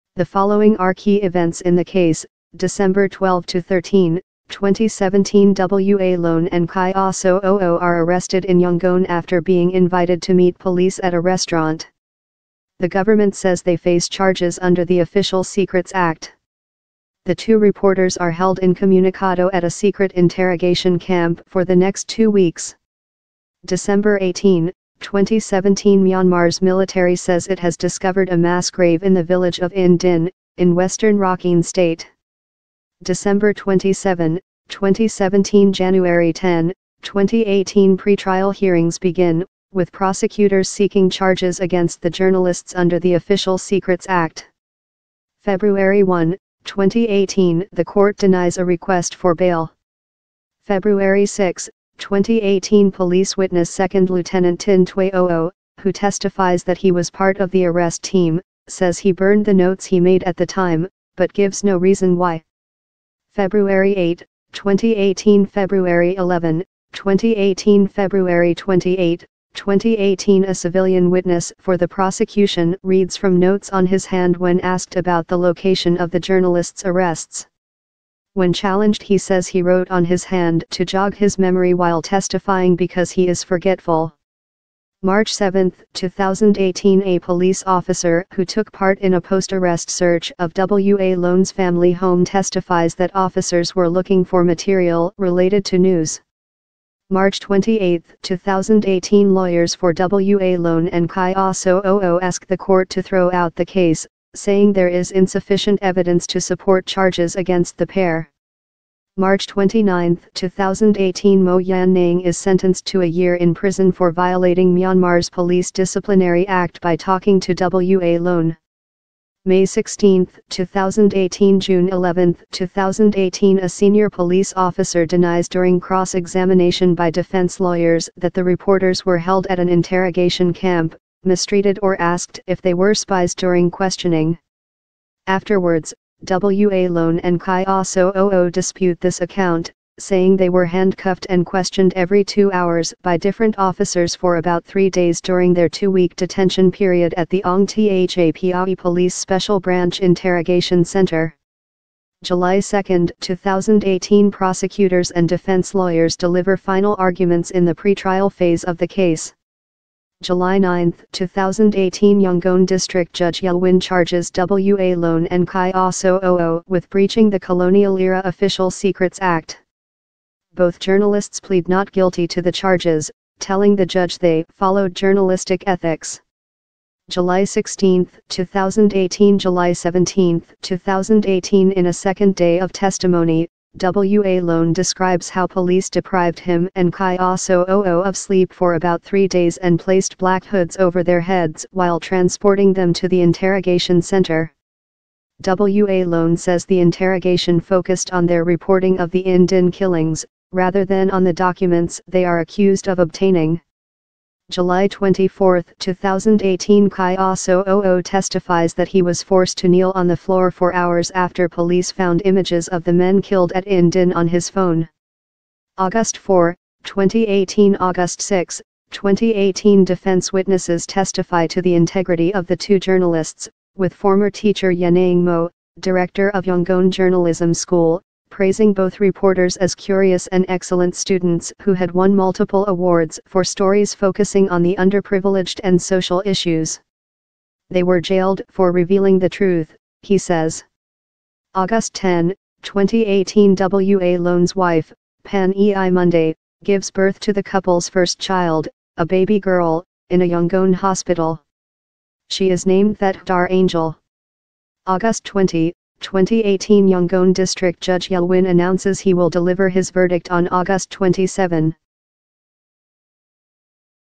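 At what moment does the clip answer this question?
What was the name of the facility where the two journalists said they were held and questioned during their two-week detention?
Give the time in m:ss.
2:27.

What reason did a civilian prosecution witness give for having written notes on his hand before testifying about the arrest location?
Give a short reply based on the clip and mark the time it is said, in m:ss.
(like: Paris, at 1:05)
He is forgetful, at 1:23.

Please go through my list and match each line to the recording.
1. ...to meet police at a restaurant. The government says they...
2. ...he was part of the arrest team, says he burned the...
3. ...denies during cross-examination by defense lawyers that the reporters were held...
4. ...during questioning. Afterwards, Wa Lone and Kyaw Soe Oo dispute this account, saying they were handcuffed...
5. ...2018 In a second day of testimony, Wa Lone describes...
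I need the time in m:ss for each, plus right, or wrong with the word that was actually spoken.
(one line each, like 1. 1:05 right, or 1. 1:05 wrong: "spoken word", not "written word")
1. 0:10 right
2. 0:56 right
3. 2:05 right
4. 2:13 right
5. 3:00 right.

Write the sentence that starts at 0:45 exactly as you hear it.
February 1, 2018 The court denies a request for bail.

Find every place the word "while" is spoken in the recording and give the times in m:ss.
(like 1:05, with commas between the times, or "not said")
1:21, 3:11.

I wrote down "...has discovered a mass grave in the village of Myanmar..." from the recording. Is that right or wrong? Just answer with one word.
wrong.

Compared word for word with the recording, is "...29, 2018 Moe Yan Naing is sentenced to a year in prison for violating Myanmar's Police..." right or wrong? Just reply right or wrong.
right.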